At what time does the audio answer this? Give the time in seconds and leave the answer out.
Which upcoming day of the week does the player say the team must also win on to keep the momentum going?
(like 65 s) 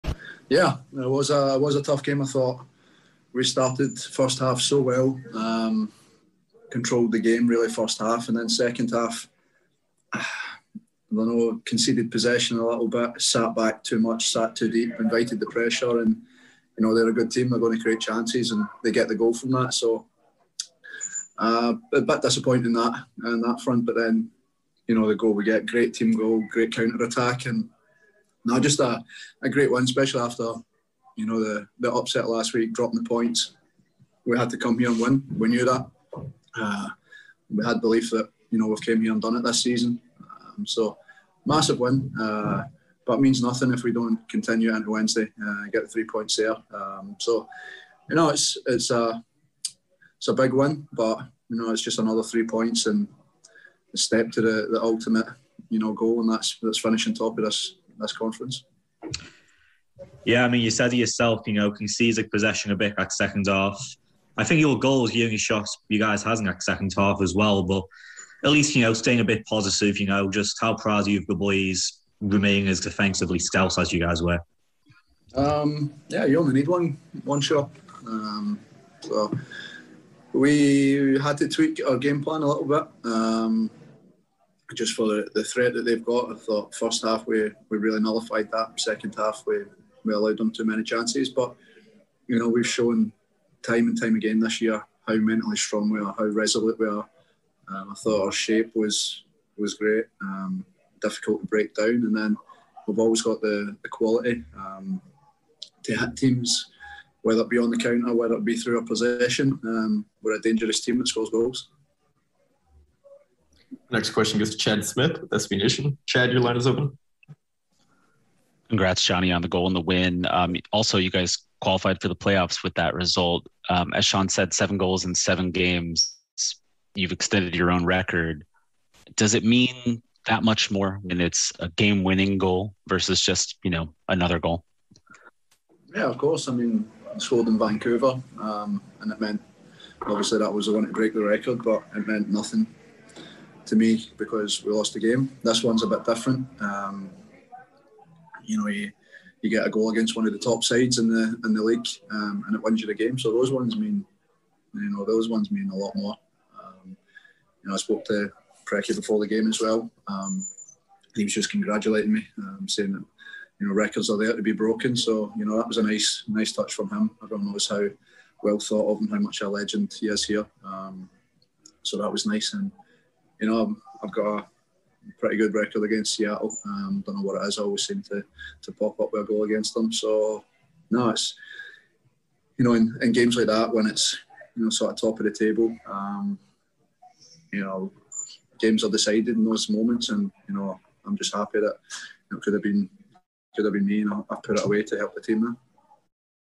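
44 s.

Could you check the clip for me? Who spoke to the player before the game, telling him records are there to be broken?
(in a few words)
Preki.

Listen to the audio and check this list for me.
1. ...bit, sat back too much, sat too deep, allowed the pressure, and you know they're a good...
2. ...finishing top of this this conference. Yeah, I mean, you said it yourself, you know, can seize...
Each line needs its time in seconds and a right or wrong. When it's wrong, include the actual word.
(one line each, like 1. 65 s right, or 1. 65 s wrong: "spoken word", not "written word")
1. 12 s wrong: "invited", not "allowed"
2. 56 s right.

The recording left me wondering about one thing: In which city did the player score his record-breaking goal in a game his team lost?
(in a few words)
Vancouver.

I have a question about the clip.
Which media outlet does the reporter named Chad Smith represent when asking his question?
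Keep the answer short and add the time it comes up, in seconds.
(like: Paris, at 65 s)
SB Nation, at 115 s.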